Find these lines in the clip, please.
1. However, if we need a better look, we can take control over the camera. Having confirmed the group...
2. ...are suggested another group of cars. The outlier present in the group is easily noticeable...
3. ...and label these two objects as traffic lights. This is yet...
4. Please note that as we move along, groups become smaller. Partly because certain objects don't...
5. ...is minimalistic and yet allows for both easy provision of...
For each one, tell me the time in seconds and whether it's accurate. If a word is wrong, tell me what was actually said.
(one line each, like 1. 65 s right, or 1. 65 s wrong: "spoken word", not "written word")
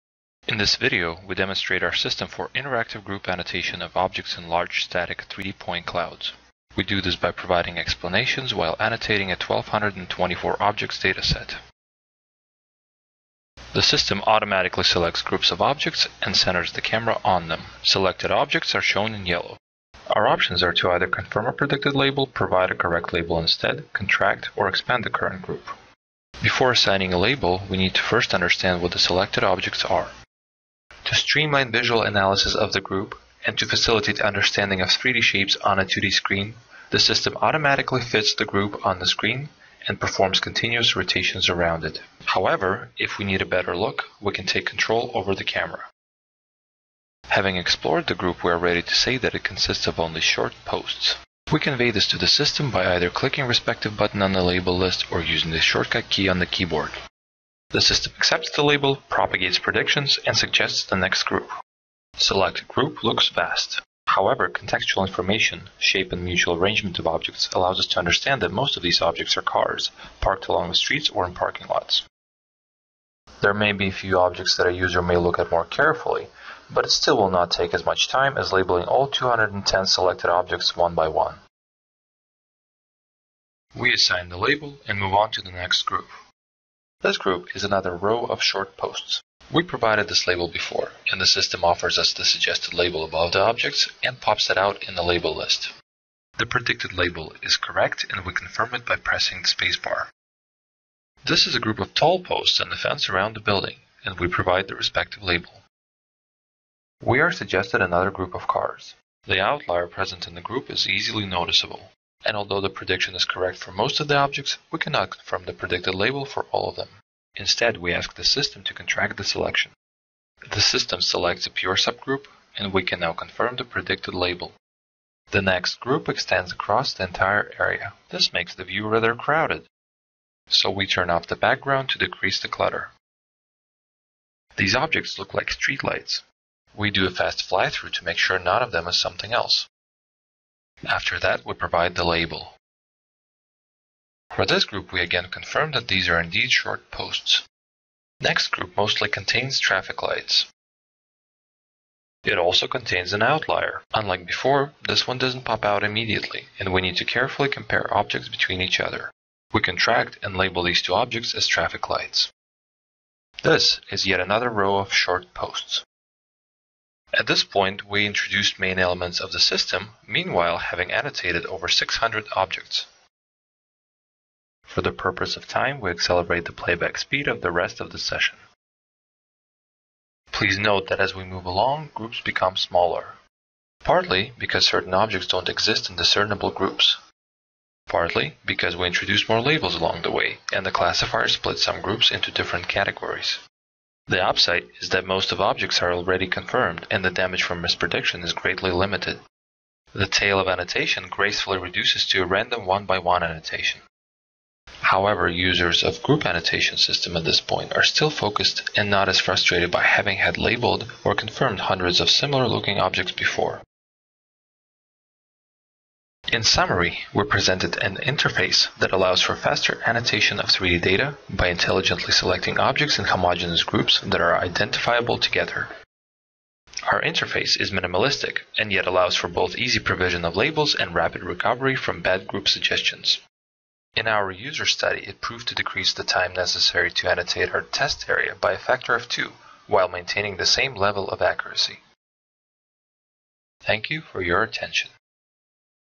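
1. 42 s wrong: "explored", not "confirmed"
2. 107 s right
3. 160 s right
4. 180 s right
5. 227 s right.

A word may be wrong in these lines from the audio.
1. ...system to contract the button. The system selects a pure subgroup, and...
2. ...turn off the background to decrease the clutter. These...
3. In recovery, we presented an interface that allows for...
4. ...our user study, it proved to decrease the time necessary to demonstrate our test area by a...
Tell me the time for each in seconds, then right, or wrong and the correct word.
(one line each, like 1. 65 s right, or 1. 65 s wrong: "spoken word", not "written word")
1. 118 s wrong: "selection", not "button"
2. 130 s right
3. 216 s wrong: "summary", not "recovery"
4. 234 s wrong: "annotate", not "demonstrate".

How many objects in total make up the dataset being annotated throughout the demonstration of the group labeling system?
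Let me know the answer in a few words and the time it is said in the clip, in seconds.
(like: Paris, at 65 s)
1224, at 9 s.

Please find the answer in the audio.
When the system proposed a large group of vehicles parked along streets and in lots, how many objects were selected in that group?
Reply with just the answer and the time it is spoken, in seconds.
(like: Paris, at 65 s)
210, at 79 s.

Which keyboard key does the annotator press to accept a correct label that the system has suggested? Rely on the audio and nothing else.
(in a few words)
spacebar.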